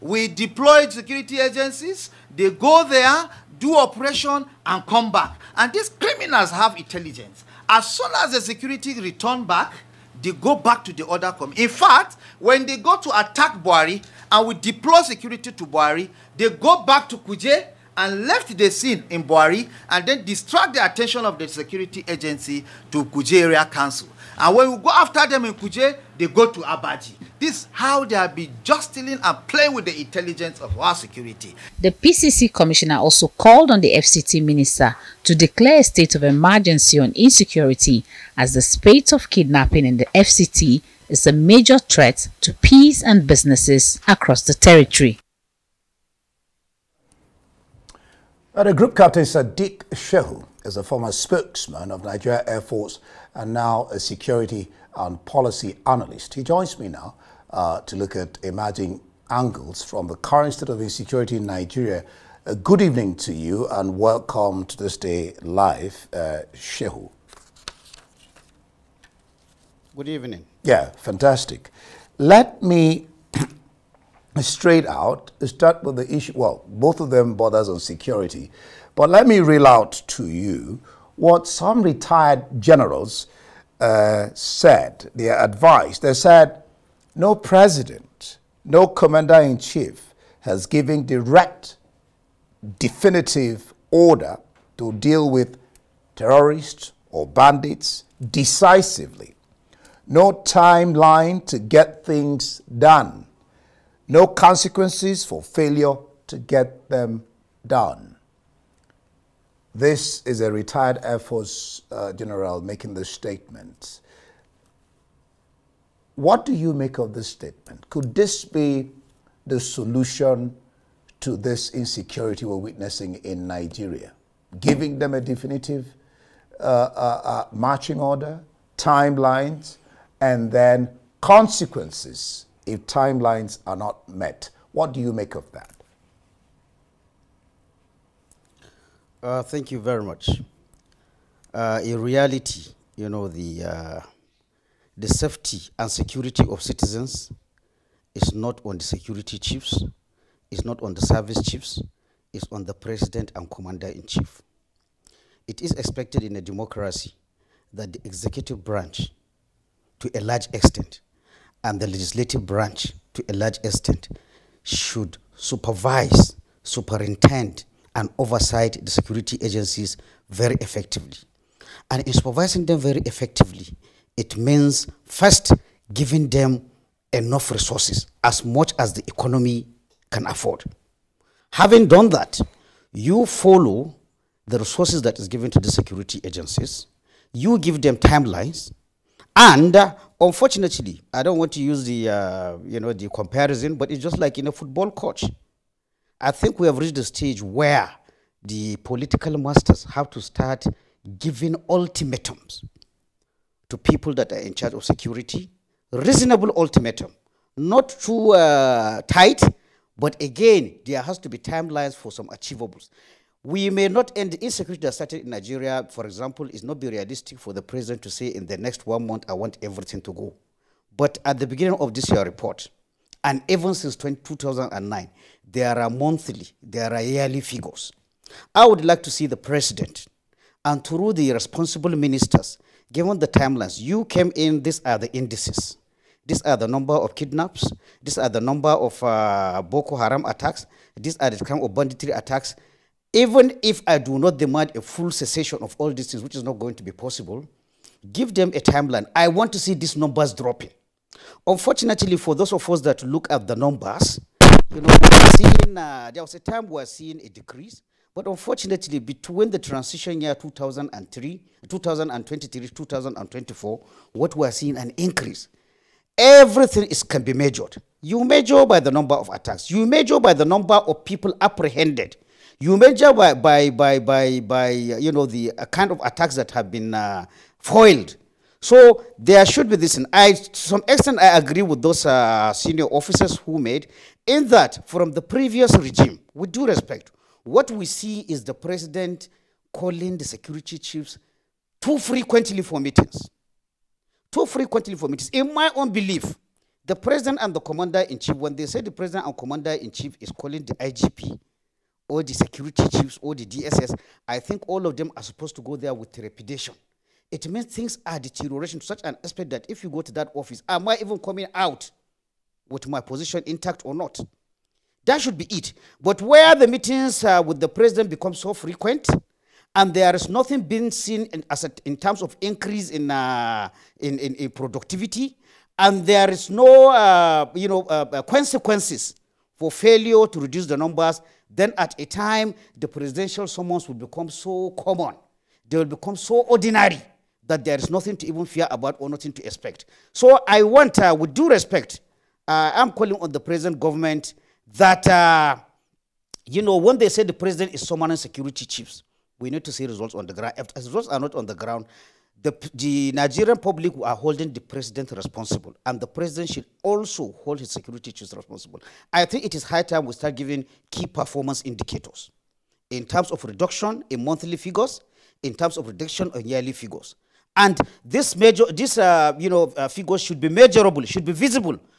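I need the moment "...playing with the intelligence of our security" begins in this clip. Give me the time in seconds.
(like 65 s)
29 s.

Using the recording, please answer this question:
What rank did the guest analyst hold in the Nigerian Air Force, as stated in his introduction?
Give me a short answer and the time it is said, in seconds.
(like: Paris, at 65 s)
Group captain, at 48 s.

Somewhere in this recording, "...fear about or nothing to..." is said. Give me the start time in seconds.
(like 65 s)
338 s.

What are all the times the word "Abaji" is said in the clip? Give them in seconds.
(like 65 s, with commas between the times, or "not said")
26 s.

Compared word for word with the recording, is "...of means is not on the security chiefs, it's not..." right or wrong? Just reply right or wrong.
wrong.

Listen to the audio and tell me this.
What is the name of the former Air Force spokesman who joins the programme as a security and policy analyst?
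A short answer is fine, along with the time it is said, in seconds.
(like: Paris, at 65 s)
Sadeeq Shehu, at 49 s.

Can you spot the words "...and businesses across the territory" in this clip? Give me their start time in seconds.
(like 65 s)
43 s.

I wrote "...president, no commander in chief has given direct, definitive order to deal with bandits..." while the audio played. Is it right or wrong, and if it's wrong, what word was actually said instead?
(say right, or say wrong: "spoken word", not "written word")
wrong: "terrorists", not "bandits".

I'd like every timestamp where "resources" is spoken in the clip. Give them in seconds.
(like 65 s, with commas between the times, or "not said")
177 s, 184 s.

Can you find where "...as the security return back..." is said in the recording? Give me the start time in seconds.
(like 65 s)
8 s.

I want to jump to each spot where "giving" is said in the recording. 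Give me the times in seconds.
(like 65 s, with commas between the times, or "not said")
124 s, 175 s, 201 s, 360 s.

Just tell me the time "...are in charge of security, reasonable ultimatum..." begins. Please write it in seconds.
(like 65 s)
204 s.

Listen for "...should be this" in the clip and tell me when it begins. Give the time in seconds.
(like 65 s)
279 s.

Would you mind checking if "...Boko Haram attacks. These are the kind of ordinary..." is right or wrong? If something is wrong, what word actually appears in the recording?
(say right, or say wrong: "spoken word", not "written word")
wrong: "banditry", not "ordinary".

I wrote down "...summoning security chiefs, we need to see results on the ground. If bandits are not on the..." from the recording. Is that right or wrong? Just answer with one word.
wrong.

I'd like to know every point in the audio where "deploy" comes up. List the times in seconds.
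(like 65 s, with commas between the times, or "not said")
0 s, 14 s.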